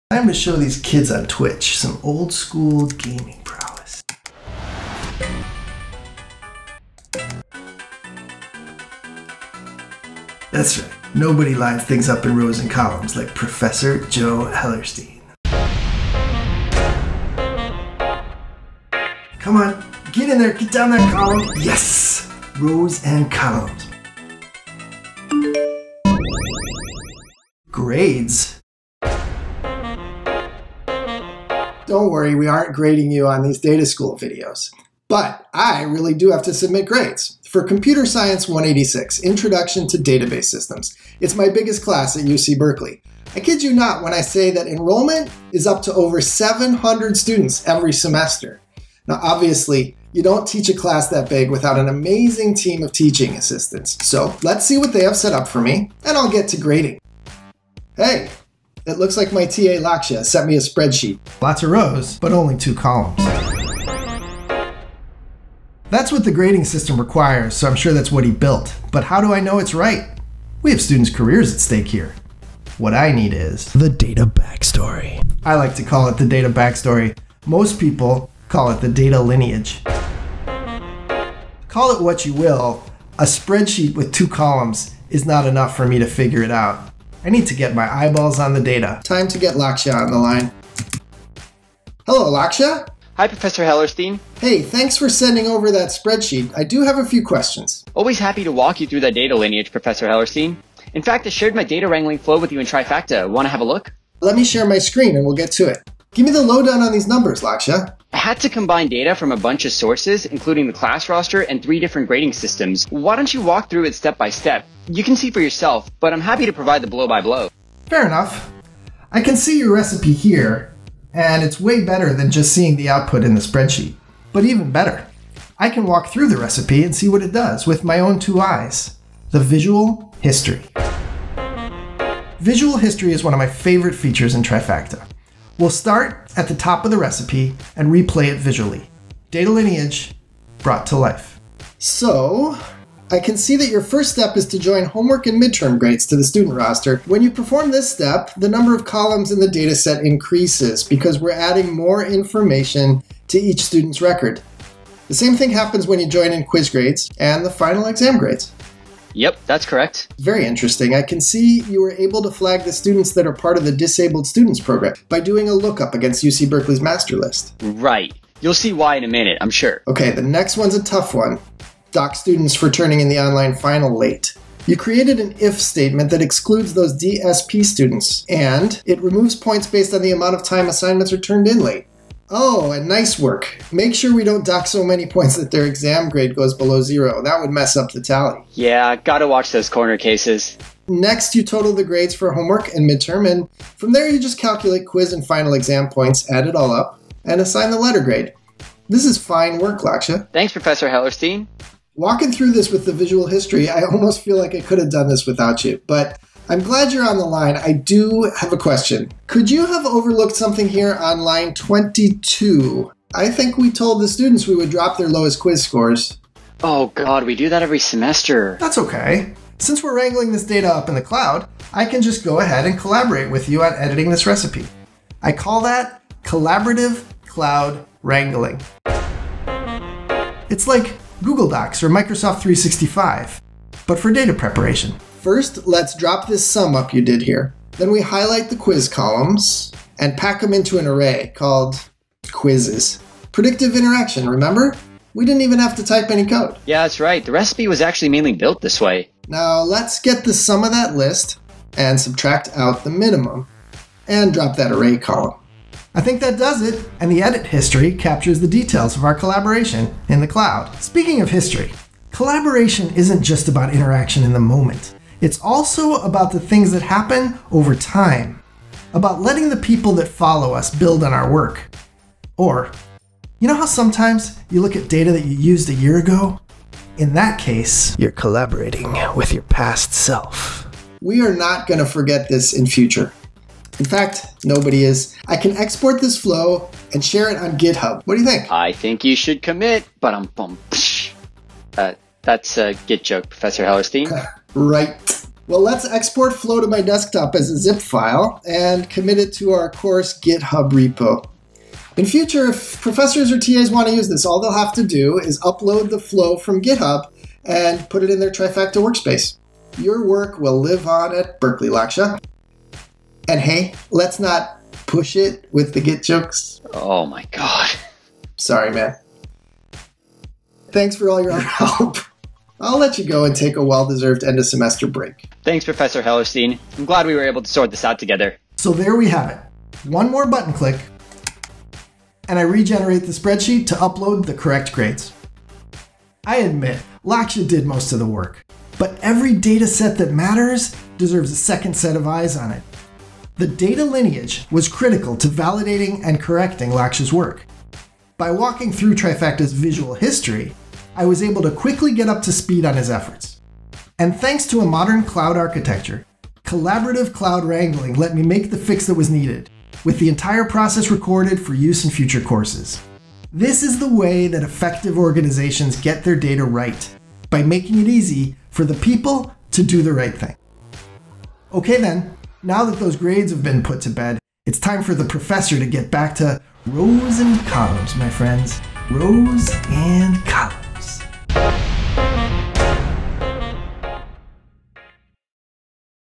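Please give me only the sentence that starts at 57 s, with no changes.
Hey, it looks like my TA Lakshya sent me a spreadsheet.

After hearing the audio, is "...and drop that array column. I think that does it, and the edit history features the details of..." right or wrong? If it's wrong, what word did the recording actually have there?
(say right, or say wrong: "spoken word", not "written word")
wrong: "captures", not "features".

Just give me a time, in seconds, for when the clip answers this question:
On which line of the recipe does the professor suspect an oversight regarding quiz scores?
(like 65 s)
211 s.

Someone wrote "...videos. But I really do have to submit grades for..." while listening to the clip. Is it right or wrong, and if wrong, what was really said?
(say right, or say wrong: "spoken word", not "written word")
right.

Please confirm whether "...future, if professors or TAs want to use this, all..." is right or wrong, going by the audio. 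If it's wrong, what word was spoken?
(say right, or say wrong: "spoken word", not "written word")
right.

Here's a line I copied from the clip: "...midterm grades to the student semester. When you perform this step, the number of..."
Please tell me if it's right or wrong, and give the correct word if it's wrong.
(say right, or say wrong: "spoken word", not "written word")
wrong: "roster", not "semester".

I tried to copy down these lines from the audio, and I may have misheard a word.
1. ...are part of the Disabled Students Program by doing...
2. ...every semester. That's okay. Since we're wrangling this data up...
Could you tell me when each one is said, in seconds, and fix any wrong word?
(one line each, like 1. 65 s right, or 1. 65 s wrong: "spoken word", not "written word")
1. 163 s right
2. 217 s right.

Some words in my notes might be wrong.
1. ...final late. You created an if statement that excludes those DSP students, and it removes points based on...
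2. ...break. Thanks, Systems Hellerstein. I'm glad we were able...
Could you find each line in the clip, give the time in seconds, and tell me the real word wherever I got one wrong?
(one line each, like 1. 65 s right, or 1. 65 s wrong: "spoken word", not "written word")
1. 173 s right
2. 324 s wrong: "Professor", not "Systems".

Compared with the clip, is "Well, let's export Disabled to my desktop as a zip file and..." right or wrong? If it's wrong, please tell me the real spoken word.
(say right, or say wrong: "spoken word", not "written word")
wrong: "Flow", not "Disabled".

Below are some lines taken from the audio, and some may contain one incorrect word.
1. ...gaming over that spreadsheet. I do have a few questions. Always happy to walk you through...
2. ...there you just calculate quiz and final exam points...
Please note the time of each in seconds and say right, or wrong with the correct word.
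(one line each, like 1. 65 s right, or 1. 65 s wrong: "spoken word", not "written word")
1. 95 s wrong: "sending", not "gaming"
2. 193 s right.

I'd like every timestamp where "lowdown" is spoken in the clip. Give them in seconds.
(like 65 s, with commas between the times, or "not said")
106 s.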